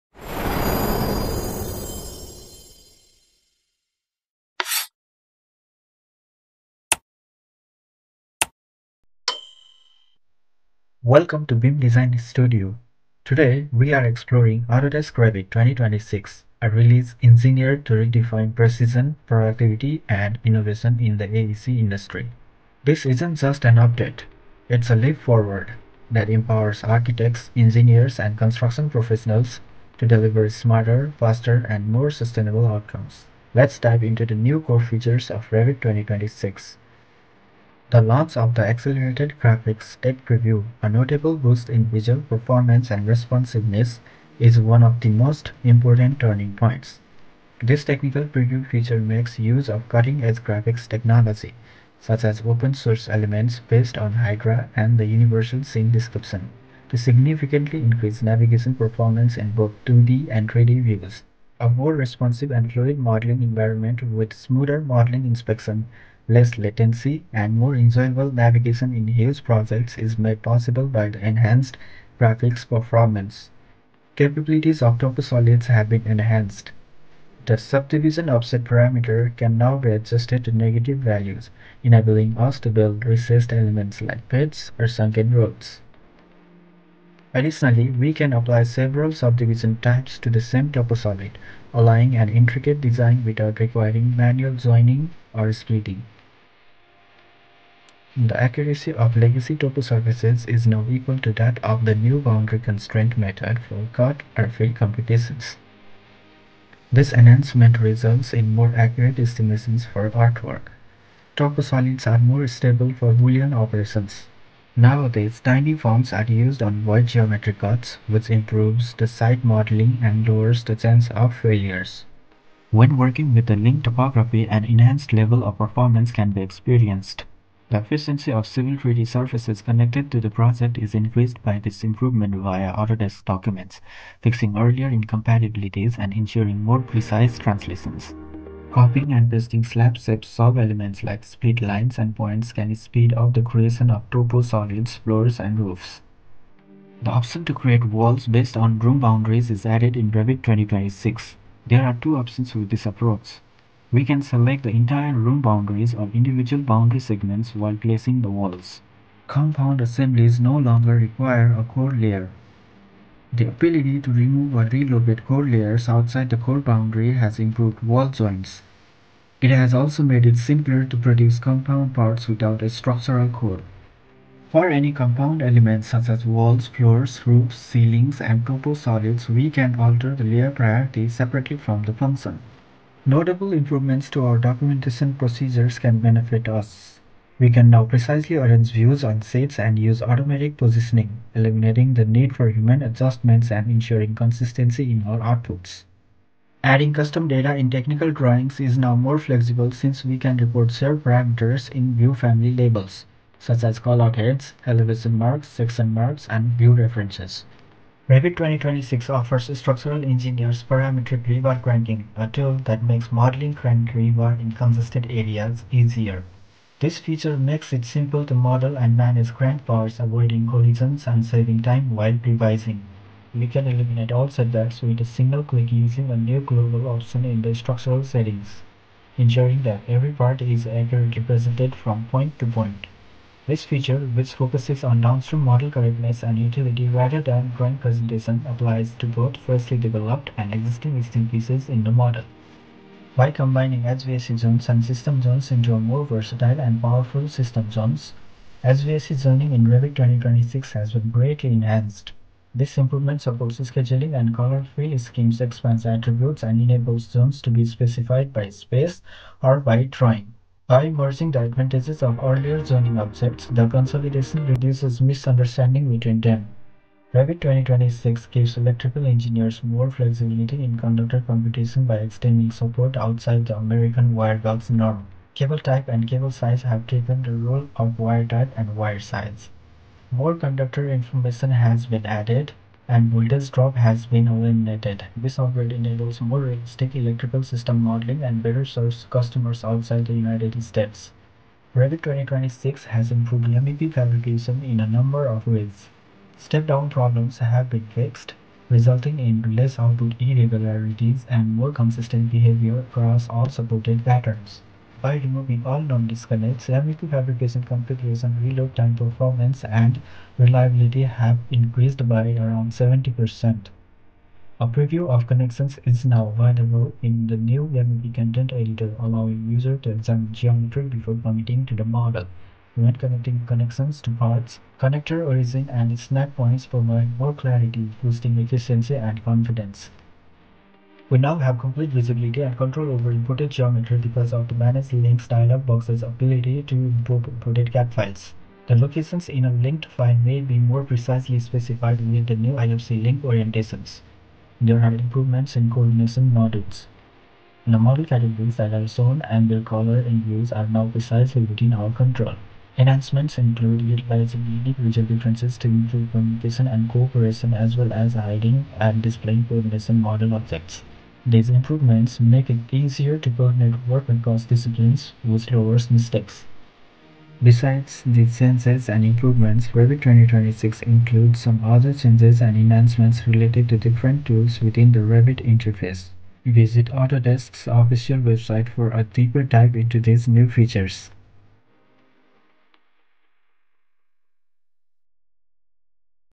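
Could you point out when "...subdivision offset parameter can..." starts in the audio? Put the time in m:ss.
1:17.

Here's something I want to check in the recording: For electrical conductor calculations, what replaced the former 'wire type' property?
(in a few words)
cable type.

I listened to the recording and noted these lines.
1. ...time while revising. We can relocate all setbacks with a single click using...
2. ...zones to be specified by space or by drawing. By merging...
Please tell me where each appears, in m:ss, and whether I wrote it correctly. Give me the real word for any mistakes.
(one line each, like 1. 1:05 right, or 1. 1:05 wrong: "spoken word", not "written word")
1. 3:41 wrong: "eliminate", not "relocate"
2. 4:17 right.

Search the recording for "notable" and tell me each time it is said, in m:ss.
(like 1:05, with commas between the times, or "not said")
0:40, 3:03.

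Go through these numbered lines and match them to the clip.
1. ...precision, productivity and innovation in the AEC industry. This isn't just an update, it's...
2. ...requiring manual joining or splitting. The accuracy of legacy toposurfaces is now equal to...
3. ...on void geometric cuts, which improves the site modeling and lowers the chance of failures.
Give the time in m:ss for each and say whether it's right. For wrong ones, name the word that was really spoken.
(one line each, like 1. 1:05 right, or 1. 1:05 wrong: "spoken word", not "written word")
1. 0:18 right
2. 1:33 right
3. 1:56 right.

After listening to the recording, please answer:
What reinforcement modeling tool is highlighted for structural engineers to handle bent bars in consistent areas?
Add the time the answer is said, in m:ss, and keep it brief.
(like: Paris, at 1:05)
parametric rebar cranking, at 3:30.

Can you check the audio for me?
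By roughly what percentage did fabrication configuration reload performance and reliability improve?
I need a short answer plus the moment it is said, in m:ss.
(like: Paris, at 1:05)
70%, at 5:12.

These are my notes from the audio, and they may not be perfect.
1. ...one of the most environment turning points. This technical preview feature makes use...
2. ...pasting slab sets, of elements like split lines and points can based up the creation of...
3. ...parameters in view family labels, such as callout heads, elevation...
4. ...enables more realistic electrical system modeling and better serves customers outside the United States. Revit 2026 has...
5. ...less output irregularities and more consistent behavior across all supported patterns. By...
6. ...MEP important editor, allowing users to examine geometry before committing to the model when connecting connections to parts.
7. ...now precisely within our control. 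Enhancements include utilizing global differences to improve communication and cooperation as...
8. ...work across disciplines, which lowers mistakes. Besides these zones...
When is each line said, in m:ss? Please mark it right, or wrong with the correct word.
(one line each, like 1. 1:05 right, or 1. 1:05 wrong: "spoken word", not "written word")
1. 0:44 wrong: "important", not "environment"
2. 2:19 wrong: "speed", not "based"
3. 3:21 right
4. 4:45 right
5. 4:59 right
6. 5:17 wrong: "content", not "important"
7. 5:50 wrong: "individual", not "global"
8. 6:03 wrong: "changes", not "zones".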